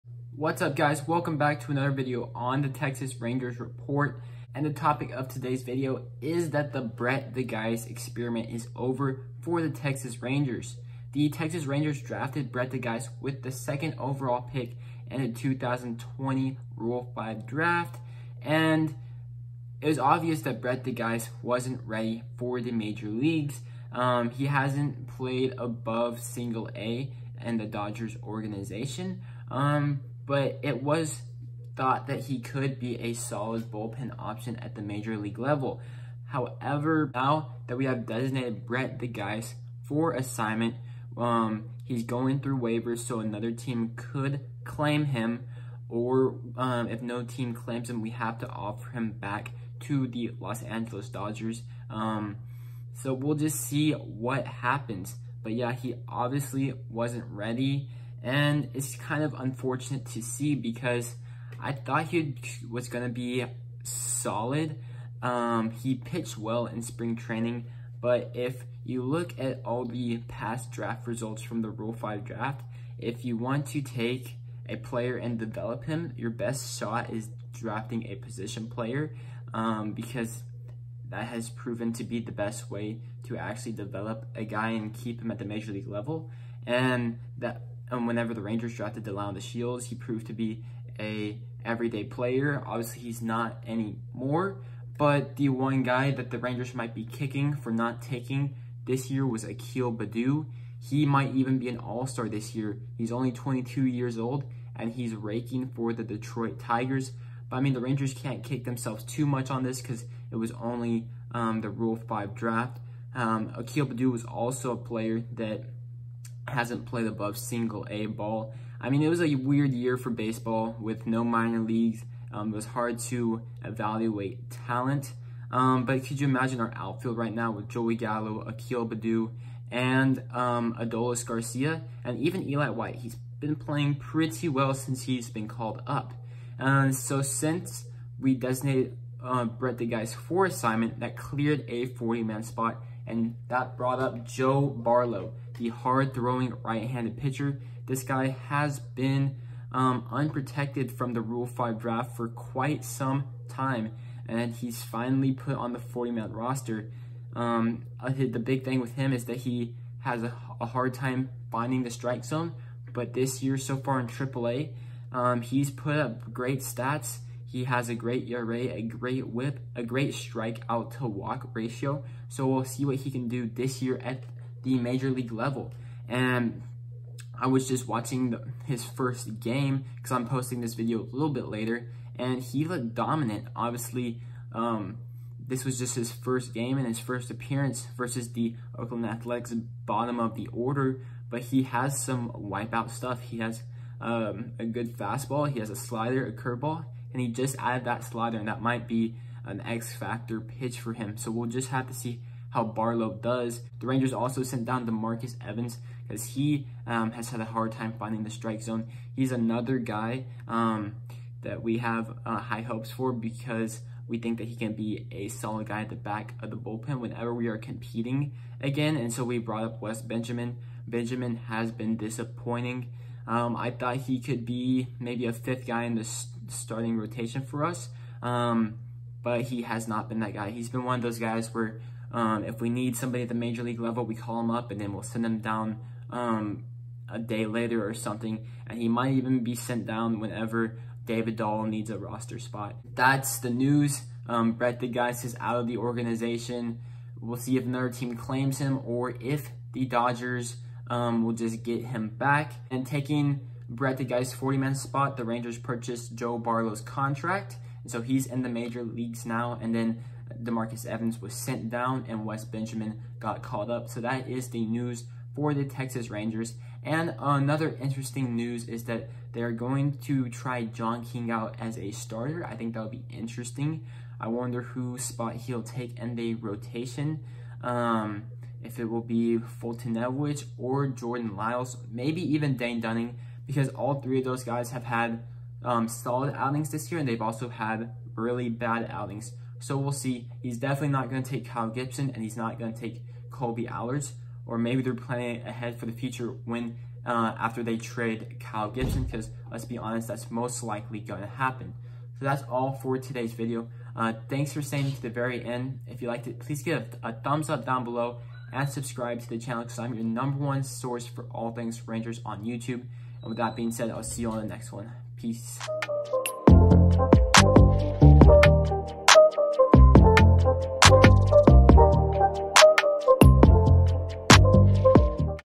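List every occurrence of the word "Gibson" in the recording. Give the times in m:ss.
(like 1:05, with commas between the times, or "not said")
4:51, 4:58.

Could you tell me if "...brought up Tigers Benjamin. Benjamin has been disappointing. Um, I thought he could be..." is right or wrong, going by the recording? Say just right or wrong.
wrong.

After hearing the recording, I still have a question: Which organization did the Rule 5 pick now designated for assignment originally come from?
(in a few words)
Los Angeles Dodgers.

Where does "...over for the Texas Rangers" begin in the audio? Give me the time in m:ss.
0:08.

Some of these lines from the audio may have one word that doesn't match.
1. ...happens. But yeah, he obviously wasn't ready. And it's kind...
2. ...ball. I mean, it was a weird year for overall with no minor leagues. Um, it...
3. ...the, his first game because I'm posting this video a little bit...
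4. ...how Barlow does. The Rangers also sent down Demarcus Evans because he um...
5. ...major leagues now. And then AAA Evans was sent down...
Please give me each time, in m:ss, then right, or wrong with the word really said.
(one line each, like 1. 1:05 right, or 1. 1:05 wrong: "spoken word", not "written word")
1. 0:54 right
2. 1:58 wrong: "baseball", not "overall"
3. 2:58 right
4. 3:22 right
5. 4:18 wrong: "Demarcus", not "AAA".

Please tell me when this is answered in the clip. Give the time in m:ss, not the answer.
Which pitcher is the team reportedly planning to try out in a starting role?
4:30.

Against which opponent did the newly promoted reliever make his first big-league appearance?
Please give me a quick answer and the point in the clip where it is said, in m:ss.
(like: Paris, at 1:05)
Oakland Athletics, at 3:08.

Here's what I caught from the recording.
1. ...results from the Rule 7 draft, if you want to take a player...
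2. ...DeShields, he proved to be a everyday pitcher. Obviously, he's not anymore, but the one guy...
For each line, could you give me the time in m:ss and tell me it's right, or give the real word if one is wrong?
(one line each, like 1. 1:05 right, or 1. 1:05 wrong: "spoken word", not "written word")
1. 1:11 wrong: "5", not "7"
2. 1:29 wrong: "player", not "pitcher".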